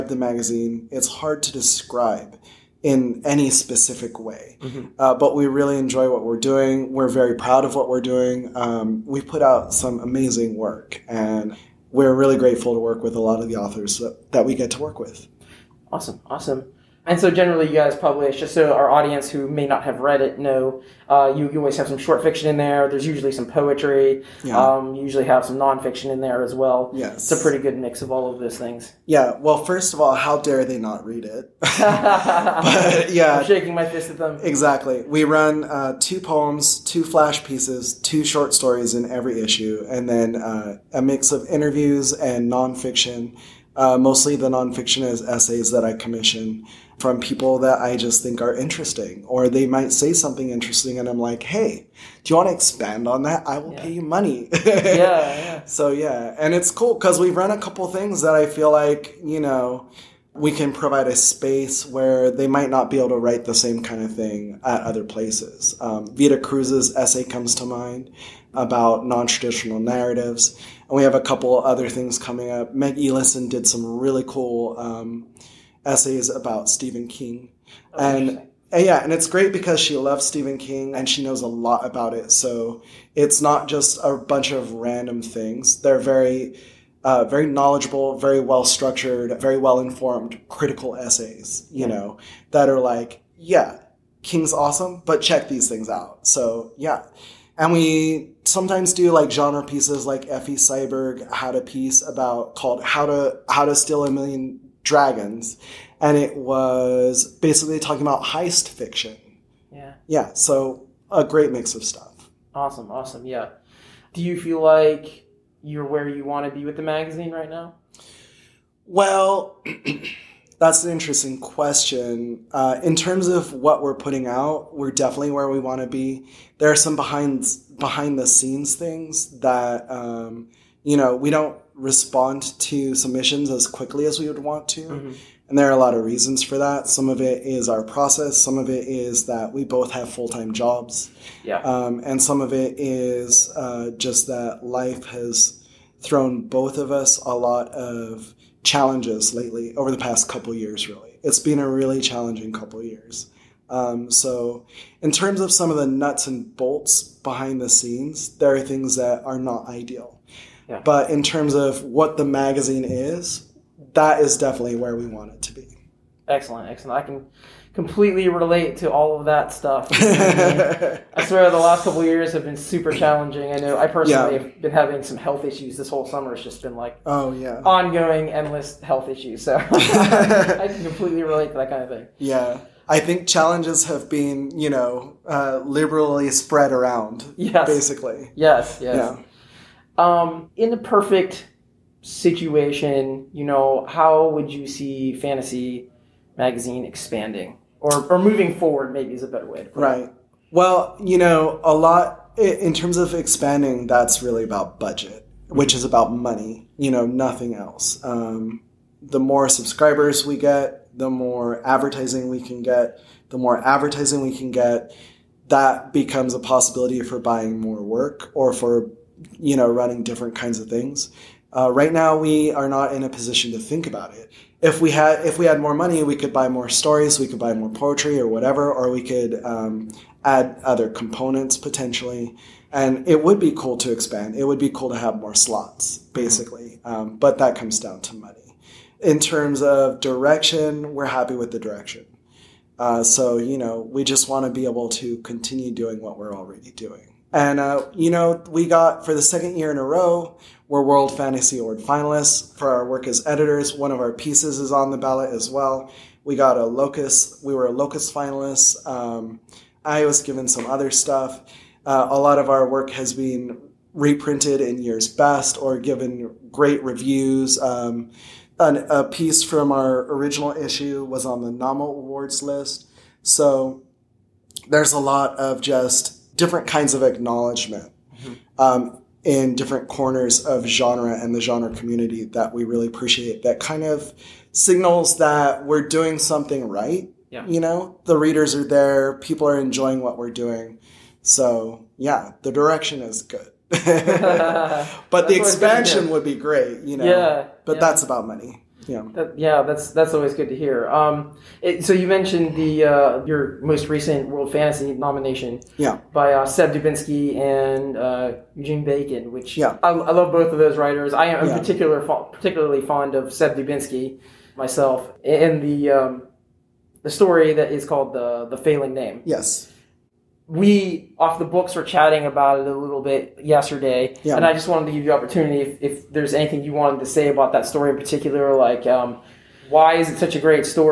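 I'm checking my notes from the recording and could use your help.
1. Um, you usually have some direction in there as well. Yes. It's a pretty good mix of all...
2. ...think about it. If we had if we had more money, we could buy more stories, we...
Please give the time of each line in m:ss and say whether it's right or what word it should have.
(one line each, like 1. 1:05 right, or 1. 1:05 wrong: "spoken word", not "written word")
1. 0:24 wrong: "nonfiction", not "direction"
2. 3:43 right.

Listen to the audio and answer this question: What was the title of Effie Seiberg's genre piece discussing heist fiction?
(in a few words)
How to Steal a Million Dragons.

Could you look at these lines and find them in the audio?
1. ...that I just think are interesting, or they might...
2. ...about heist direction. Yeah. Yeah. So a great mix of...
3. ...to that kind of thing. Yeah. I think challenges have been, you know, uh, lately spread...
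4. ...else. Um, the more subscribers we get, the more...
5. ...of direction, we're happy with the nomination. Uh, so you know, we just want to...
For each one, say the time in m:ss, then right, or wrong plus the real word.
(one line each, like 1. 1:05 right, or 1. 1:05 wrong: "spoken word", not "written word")
1. 0:47 right
2. 1:48 wrong: "fiction", not "direction"
3. 3:01 wrong: "liberally", not "lately"
4. 3:27 right
5. 3:59 wrong: "direction", not "nomination".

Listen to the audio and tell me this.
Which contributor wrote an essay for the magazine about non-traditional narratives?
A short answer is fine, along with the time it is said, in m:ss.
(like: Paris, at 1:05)
Vida Cruz, at 1:06.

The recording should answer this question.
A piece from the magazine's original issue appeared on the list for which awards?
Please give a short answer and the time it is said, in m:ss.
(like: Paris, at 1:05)
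Nommo Awards, at 4:31.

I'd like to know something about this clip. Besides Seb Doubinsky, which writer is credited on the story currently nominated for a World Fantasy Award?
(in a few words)
Eugen Bacon.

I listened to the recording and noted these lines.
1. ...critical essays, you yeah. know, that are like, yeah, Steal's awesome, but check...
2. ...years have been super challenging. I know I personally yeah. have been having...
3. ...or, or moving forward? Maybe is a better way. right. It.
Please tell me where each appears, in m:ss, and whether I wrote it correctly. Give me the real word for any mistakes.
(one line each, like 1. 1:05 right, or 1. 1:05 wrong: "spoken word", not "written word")
1. 1:30 wrong: "King", not "Steal"
2. 2:52 right
3. 3:17 right.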